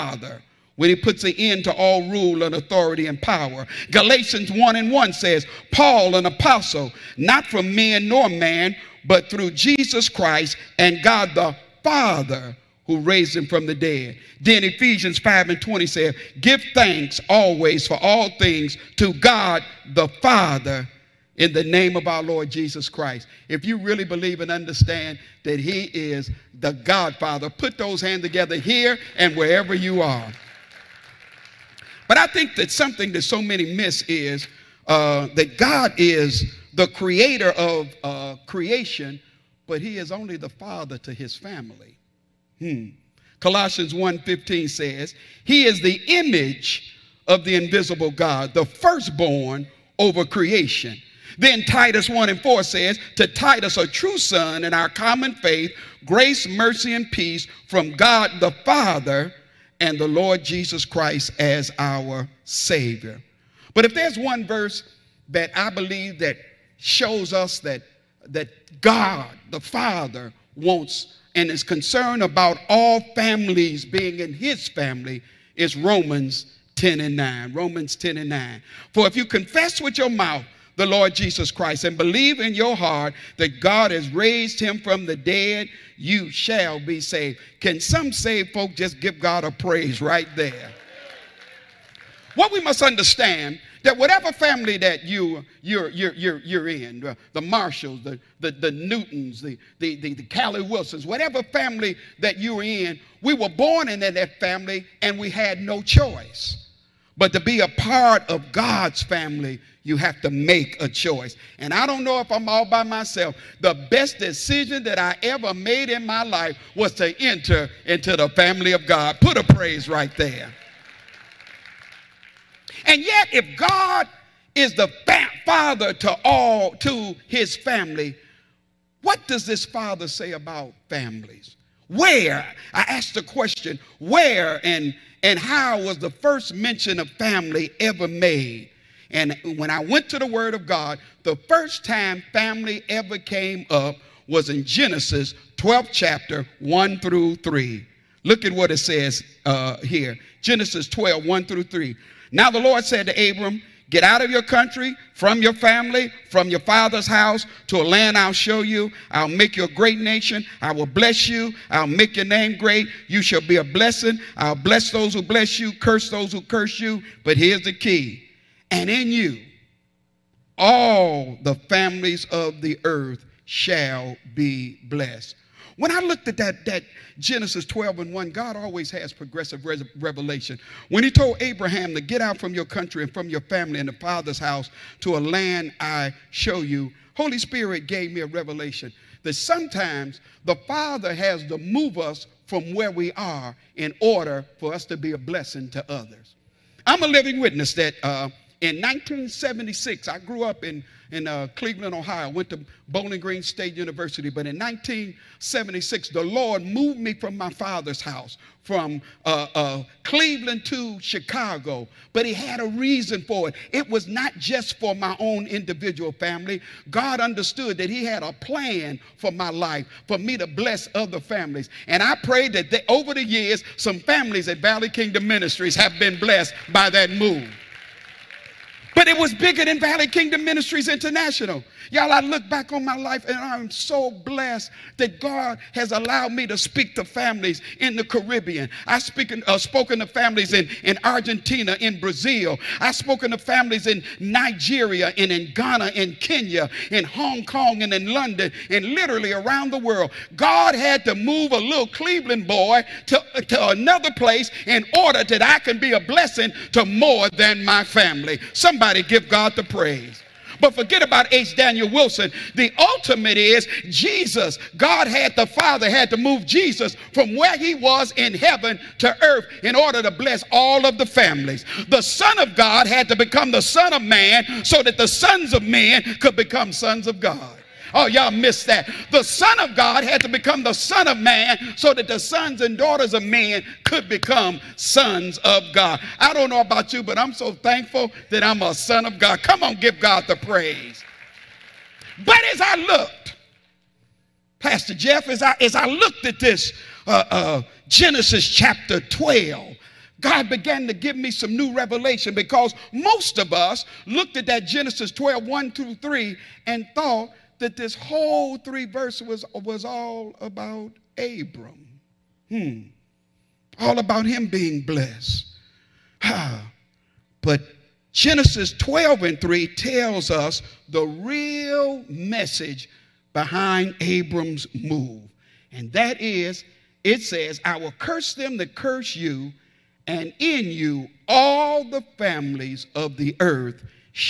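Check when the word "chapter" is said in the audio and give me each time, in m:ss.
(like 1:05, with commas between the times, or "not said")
2:25, 4:58.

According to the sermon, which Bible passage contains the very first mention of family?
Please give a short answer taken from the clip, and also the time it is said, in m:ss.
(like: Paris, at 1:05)
Genesis 12:1-3, at 2:24.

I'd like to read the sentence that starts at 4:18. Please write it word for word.
Somebody Somebody give God the praise.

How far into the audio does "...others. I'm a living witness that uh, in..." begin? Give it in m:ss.
3:15.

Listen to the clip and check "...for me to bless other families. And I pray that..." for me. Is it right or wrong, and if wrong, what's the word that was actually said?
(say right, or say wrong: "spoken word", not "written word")
right.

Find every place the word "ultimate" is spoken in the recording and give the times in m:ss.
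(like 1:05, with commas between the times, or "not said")
4:22.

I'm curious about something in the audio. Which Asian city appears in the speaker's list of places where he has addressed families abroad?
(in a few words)
Hong Kong.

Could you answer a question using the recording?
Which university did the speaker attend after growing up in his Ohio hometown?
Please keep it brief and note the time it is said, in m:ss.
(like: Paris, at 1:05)
Bowling Green State University, at 3:22.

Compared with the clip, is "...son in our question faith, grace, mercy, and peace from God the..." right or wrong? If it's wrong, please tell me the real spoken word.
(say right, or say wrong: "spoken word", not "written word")
wrong: "common", not "question".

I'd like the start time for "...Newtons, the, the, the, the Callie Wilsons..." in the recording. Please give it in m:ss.
1:38.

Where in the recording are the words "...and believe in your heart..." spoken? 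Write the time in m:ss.
1:21.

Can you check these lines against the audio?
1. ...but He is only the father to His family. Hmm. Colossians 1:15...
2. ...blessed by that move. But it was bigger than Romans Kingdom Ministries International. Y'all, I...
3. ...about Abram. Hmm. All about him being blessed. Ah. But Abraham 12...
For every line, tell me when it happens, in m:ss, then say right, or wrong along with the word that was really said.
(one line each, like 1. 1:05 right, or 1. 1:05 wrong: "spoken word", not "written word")
1. 0:39 right
2. 3:46 wrong: "Valley", not "Romans"
3. 5:10 wrong: "Genesis", not "Abraham".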